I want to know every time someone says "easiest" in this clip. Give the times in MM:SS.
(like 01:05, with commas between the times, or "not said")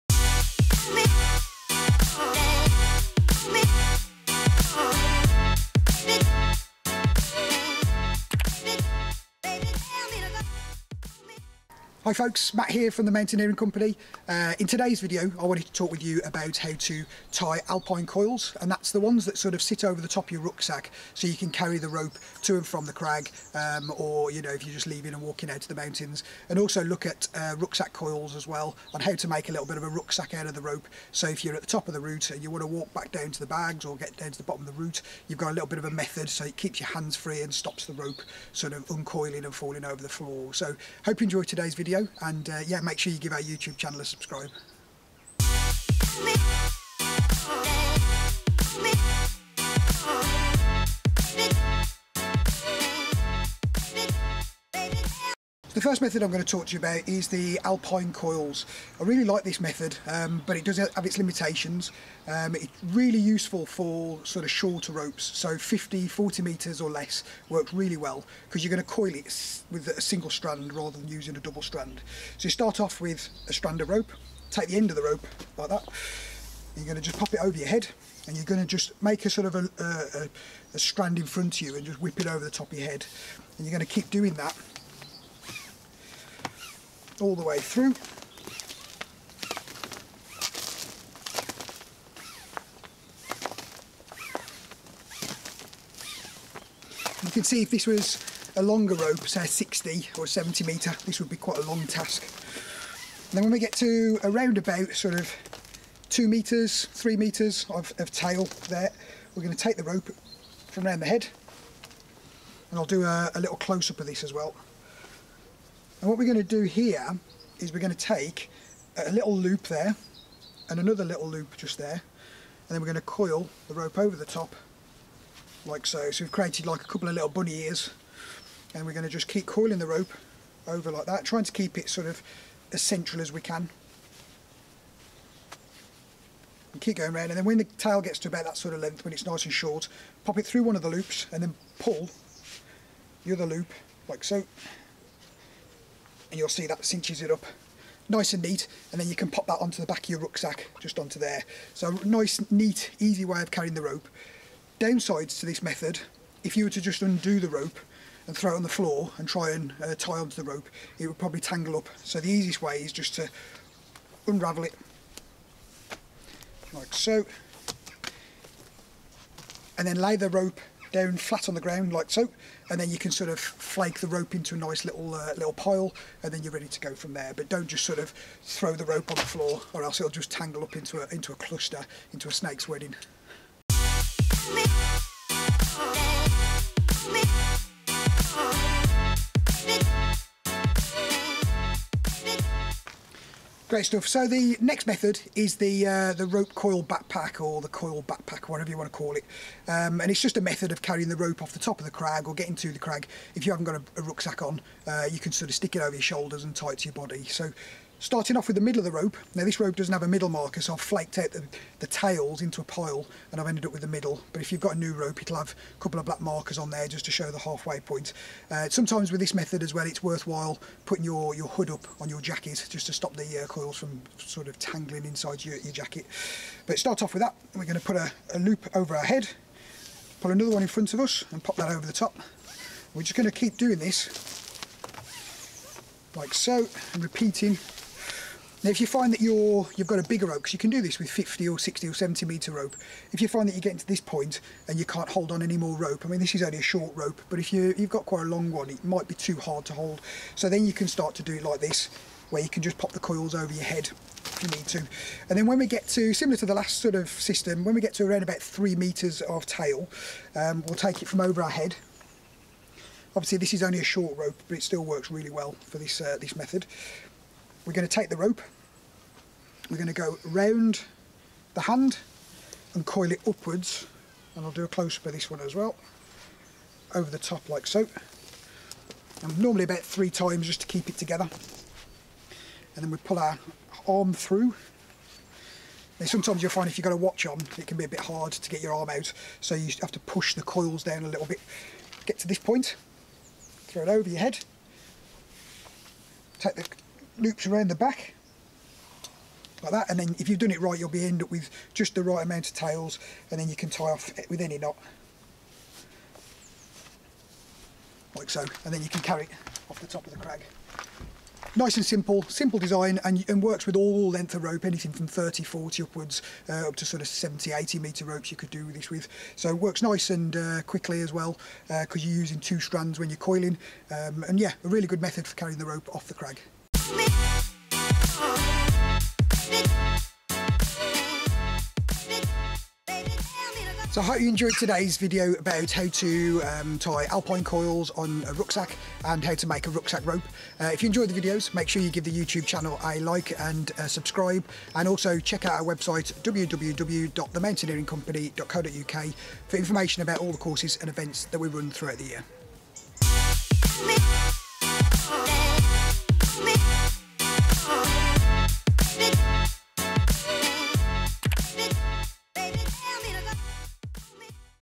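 02:42.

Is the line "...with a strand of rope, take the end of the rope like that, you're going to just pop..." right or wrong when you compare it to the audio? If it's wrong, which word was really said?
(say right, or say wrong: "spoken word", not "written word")
right.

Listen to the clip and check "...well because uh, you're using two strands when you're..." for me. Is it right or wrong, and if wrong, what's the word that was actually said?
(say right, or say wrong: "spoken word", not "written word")
right.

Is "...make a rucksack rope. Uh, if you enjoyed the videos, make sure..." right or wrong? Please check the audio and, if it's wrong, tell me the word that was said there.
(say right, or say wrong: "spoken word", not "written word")
right.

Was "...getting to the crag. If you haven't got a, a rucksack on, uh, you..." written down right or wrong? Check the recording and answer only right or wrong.
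right.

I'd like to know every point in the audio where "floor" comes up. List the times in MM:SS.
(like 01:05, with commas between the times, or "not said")
00:40, 02:38, 02:59.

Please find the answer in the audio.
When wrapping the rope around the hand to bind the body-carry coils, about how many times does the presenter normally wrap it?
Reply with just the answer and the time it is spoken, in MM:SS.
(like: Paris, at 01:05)
3, at 04:39.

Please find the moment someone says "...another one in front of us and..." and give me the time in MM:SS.
03:50.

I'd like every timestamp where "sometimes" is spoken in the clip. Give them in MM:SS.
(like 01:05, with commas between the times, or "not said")
03:38, 04:46.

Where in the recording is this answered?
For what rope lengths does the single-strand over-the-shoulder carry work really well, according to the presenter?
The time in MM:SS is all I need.
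01:05.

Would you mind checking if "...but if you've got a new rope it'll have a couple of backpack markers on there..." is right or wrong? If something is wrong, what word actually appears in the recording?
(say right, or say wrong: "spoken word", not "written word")
wrong: "black", not "backpack".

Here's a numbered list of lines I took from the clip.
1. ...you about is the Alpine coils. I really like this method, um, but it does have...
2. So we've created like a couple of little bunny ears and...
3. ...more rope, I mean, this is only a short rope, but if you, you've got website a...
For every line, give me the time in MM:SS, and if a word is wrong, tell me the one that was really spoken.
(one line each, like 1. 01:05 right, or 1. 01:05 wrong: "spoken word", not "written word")
1. 00:56 right
2. 02:06 right
3. 04:05 wrong: "quite", not "website".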